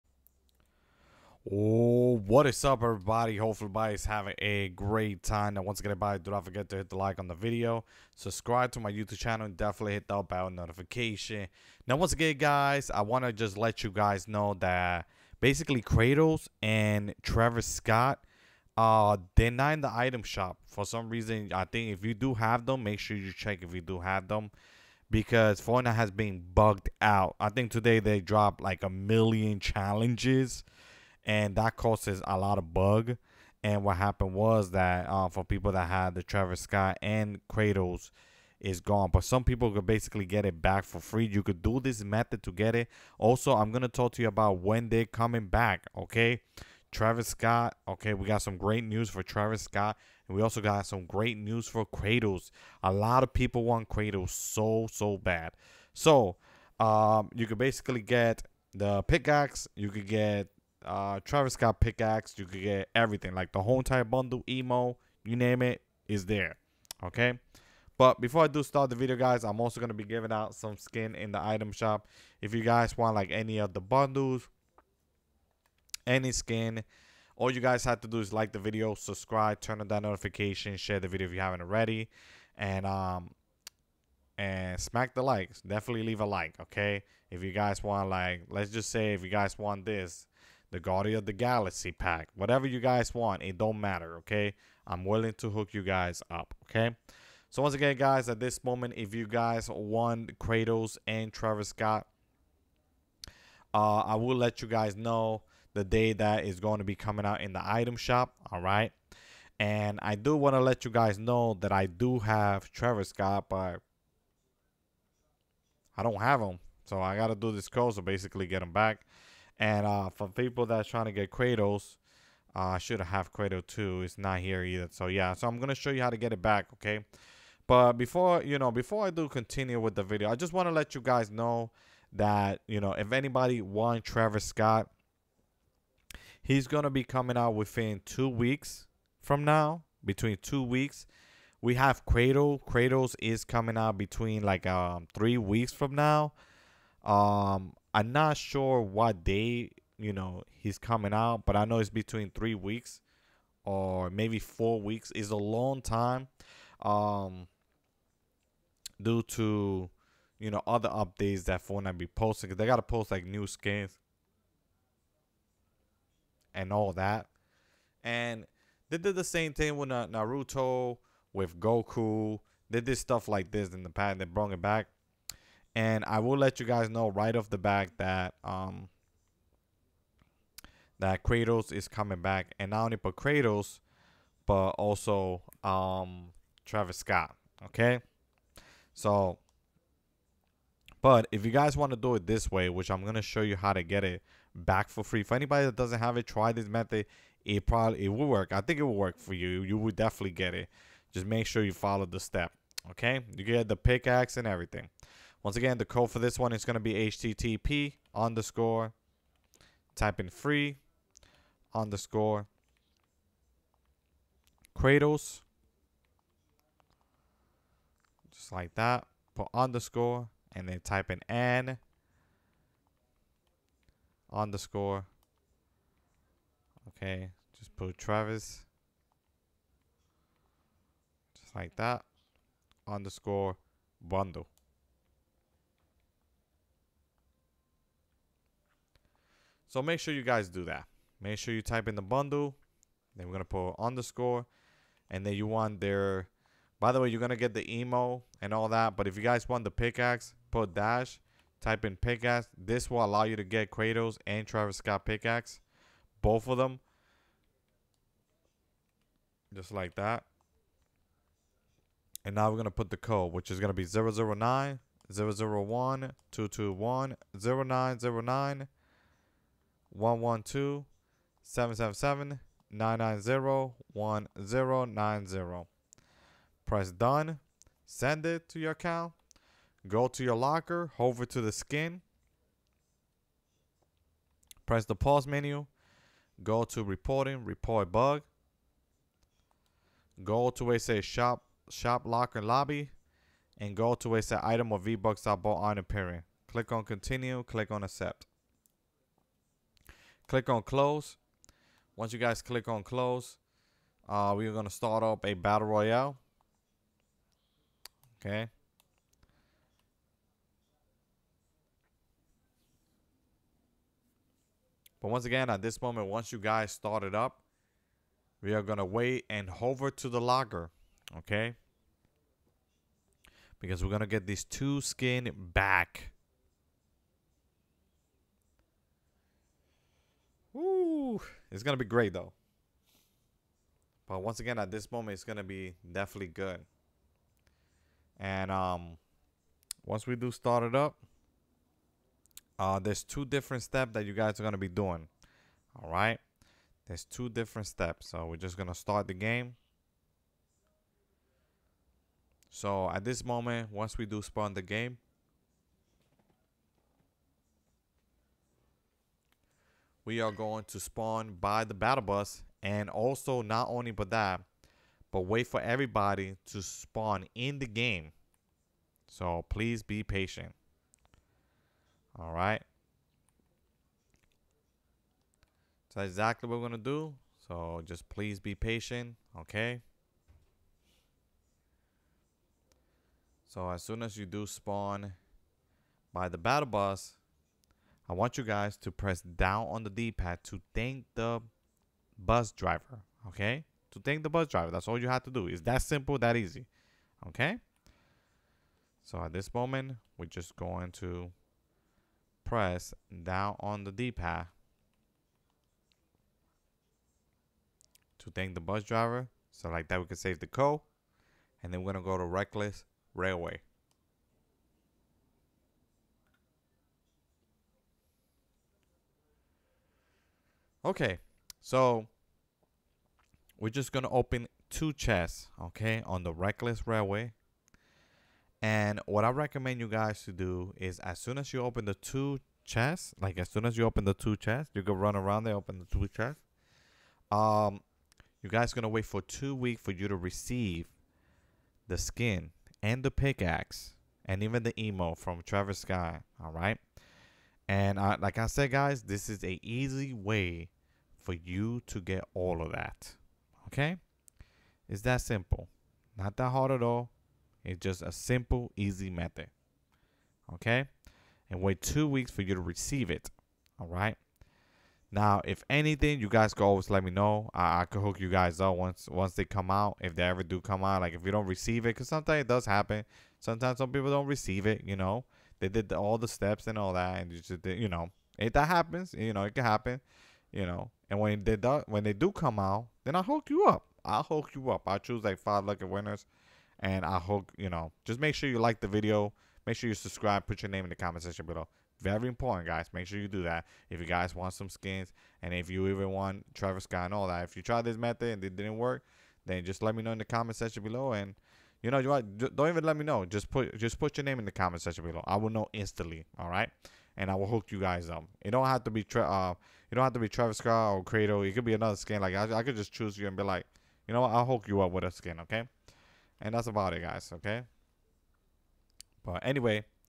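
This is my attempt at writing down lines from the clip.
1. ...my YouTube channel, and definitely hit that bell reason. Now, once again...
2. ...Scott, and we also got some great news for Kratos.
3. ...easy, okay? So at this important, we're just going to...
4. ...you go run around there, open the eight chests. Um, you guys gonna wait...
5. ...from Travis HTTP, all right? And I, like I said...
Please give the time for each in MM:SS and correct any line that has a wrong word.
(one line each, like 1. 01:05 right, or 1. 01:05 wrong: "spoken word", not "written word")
1. 00:08 wrong: "notification", not "reason"
2. 00:49 right
3. 06:36 wrong: "moment", not "important"
4. 07:14 wrong: "two", not "eight"
5. 07:25 wrong: "Scott", not "HTTP".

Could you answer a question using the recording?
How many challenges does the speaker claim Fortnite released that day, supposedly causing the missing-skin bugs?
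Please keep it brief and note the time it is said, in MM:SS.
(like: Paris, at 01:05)
a million, at 00:28.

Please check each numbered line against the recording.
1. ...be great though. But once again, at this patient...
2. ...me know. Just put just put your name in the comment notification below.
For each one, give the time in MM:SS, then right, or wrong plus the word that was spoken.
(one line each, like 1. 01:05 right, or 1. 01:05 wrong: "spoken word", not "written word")
1. 05:31 wrong: "moment", not "patient"
2. 08:22 wrong: "section", not "notification".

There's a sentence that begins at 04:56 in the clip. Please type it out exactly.
Click on continue, click on accept.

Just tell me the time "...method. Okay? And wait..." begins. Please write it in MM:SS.
07:39.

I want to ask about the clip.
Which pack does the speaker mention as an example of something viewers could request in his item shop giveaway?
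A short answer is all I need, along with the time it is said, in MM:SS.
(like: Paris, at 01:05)
Guardian of the Galaxy, at 01:30.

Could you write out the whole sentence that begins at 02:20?
Between two weeks, we have Cradle.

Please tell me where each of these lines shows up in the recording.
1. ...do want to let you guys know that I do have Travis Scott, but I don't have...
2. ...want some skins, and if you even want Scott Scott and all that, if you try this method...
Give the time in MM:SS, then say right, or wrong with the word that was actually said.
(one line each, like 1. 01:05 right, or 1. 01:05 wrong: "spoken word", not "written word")
1. 01:50 right
2. 08:14 wrong: "Travis", not "Scott".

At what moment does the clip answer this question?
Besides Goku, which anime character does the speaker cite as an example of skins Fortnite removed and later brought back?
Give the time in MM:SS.
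02:49.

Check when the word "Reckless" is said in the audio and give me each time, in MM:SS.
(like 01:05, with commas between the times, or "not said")
06:52, 07:06.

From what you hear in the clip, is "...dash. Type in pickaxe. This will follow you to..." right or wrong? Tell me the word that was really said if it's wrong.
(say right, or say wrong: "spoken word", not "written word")
wrong: "allow", not "follow".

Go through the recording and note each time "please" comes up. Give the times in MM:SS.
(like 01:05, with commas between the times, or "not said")
06:09, 06:18.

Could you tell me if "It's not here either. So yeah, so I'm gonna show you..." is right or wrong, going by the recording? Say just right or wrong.
right.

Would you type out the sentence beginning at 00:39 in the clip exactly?
But some people could basically get it back for free.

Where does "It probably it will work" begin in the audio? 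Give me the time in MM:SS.
03:17.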